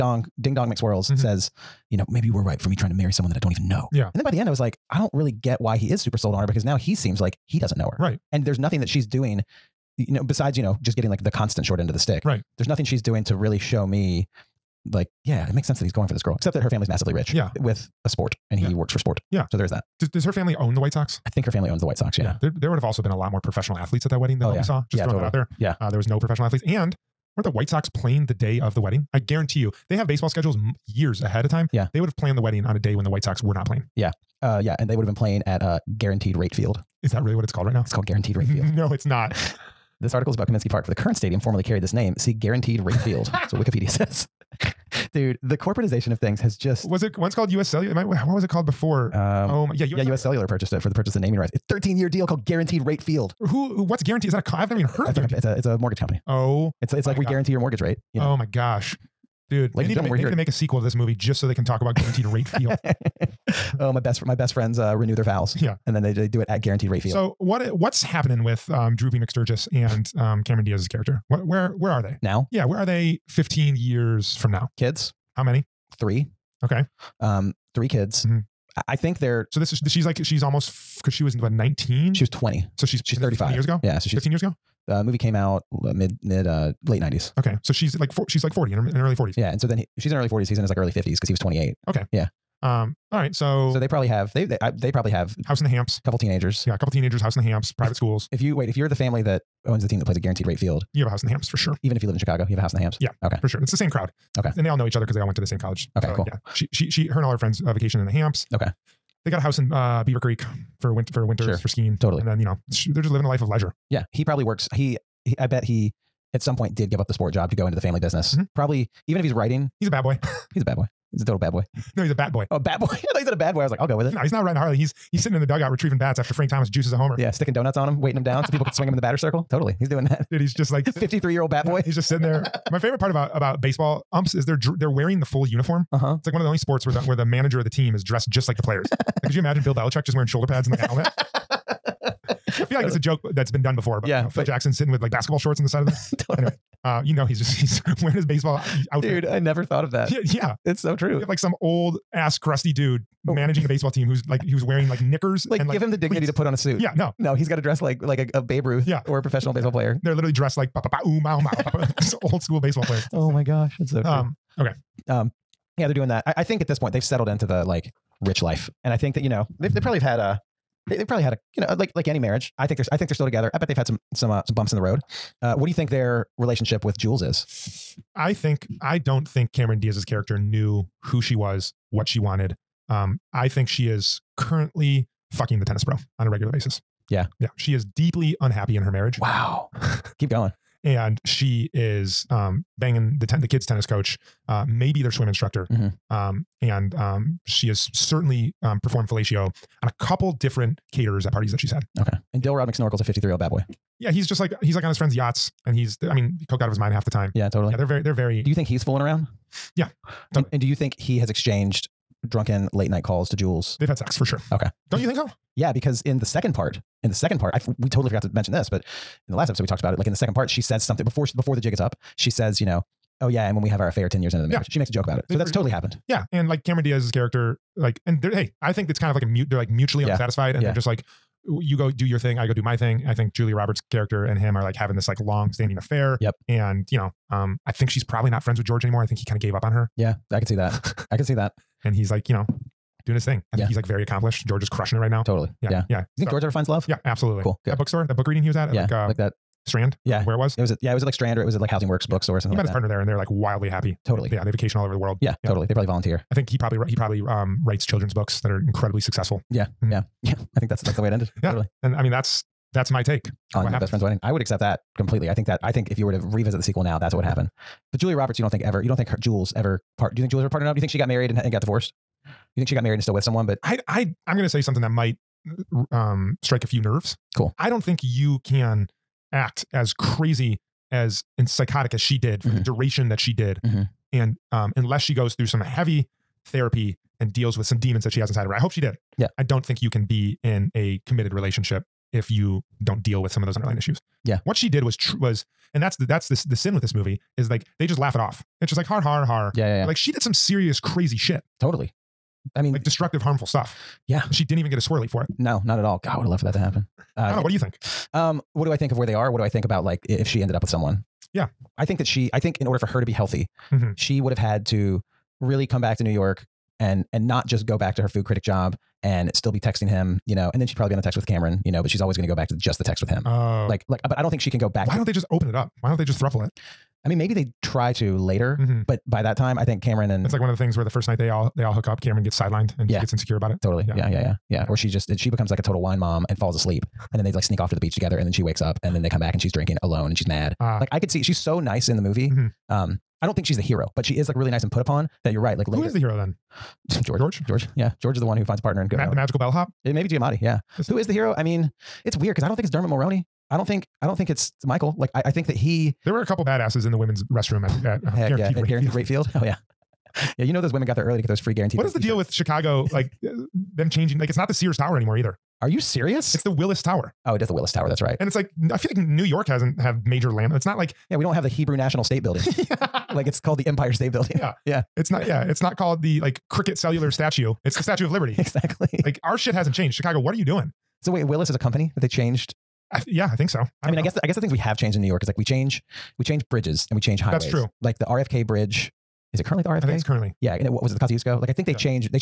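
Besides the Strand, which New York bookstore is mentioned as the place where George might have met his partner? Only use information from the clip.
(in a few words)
Housing Works.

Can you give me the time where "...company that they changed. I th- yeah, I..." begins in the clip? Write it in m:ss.
6:21.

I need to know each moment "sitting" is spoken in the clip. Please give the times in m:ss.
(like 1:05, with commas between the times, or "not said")
2:05, 2:12, 2:24.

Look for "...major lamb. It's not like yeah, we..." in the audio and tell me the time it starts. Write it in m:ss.
6:10.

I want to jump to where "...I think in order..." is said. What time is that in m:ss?
5:12.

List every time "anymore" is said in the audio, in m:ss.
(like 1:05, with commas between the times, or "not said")
3:58, 6:04.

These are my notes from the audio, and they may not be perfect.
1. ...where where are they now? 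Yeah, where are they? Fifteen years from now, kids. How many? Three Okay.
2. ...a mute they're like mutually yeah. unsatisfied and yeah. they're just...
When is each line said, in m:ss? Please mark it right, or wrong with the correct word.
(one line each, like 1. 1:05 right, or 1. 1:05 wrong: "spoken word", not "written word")
1. 1:11 right
2. 3:49 right.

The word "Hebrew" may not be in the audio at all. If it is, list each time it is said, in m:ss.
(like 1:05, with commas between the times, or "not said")
6:11.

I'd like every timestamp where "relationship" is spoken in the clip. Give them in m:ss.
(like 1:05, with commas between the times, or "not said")
2:56, 4:51.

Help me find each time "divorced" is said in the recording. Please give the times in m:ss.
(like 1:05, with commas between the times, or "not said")
4:31.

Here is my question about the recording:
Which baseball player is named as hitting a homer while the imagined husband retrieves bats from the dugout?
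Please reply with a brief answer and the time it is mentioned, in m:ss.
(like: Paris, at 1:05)
Frank Thomas, at 2:06.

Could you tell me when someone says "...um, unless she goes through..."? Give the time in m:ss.
4:44.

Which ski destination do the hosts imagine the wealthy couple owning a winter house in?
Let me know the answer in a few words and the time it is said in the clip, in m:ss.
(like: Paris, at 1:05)
Beaver Creek, at 1:50.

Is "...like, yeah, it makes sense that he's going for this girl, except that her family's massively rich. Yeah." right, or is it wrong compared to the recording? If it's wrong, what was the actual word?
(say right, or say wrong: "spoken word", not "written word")
right.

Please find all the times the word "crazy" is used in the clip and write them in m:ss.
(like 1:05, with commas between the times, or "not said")
4:39, 5:00.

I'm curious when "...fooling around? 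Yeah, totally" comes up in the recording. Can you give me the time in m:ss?
3:28.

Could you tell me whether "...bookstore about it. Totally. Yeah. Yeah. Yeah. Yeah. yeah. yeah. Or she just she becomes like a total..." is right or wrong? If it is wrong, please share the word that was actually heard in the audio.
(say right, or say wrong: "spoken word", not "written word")
wrong: "insecure", not "bookstore".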